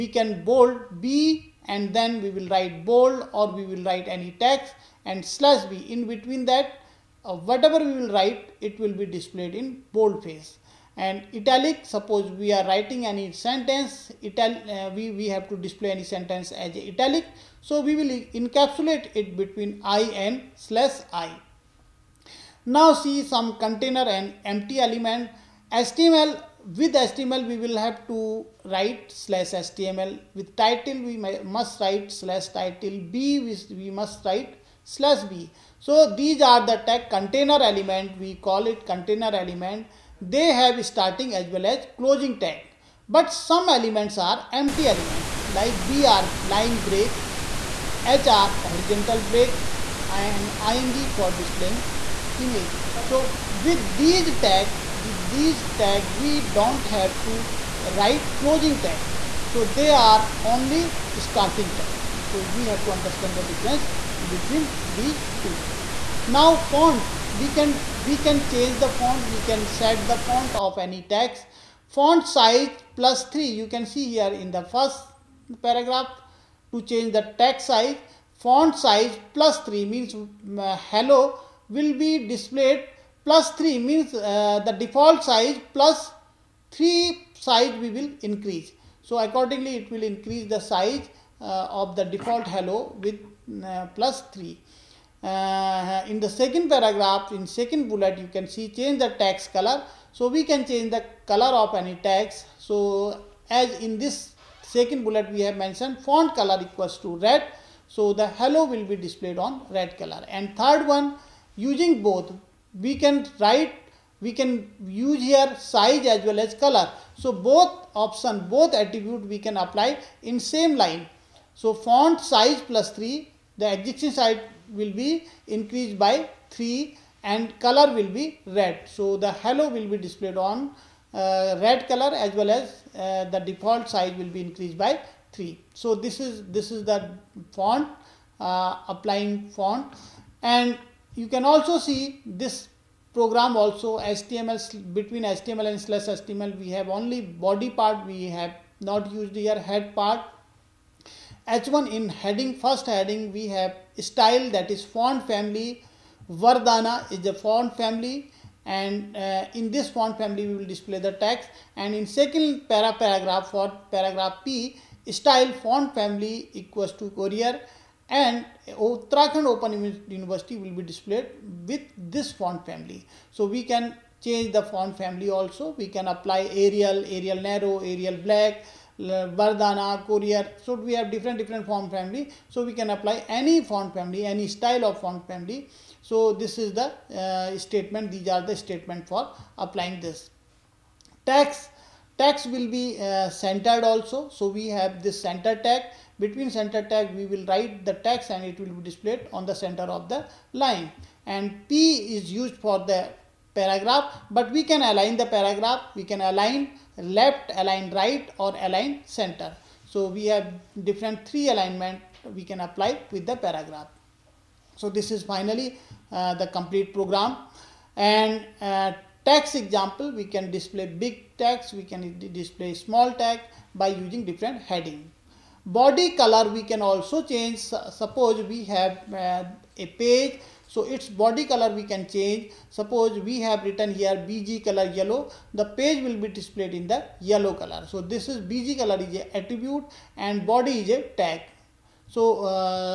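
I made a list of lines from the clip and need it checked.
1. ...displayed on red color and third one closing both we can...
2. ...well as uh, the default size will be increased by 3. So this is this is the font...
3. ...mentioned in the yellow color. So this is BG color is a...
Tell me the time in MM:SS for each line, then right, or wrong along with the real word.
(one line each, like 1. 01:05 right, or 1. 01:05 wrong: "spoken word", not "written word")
1. 01:48 wrong: "using", not "closing"
2. 02:12 right
3. 03:56 wrong: "displayed", not "mentioned".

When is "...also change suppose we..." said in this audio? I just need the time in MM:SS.
03:46.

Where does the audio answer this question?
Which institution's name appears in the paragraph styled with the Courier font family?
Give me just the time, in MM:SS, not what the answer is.
02:48.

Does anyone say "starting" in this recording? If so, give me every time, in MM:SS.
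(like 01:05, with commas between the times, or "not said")
00:40, 01:01.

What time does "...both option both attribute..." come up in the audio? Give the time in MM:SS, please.
01:57.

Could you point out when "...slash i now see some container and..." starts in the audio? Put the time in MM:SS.
00:20.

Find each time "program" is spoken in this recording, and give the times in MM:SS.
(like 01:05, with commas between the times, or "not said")
02:23, 03:36.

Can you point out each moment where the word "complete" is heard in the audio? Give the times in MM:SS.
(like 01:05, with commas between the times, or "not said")
03:36.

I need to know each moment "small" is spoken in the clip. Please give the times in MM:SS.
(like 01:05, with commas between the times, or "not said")
03:42.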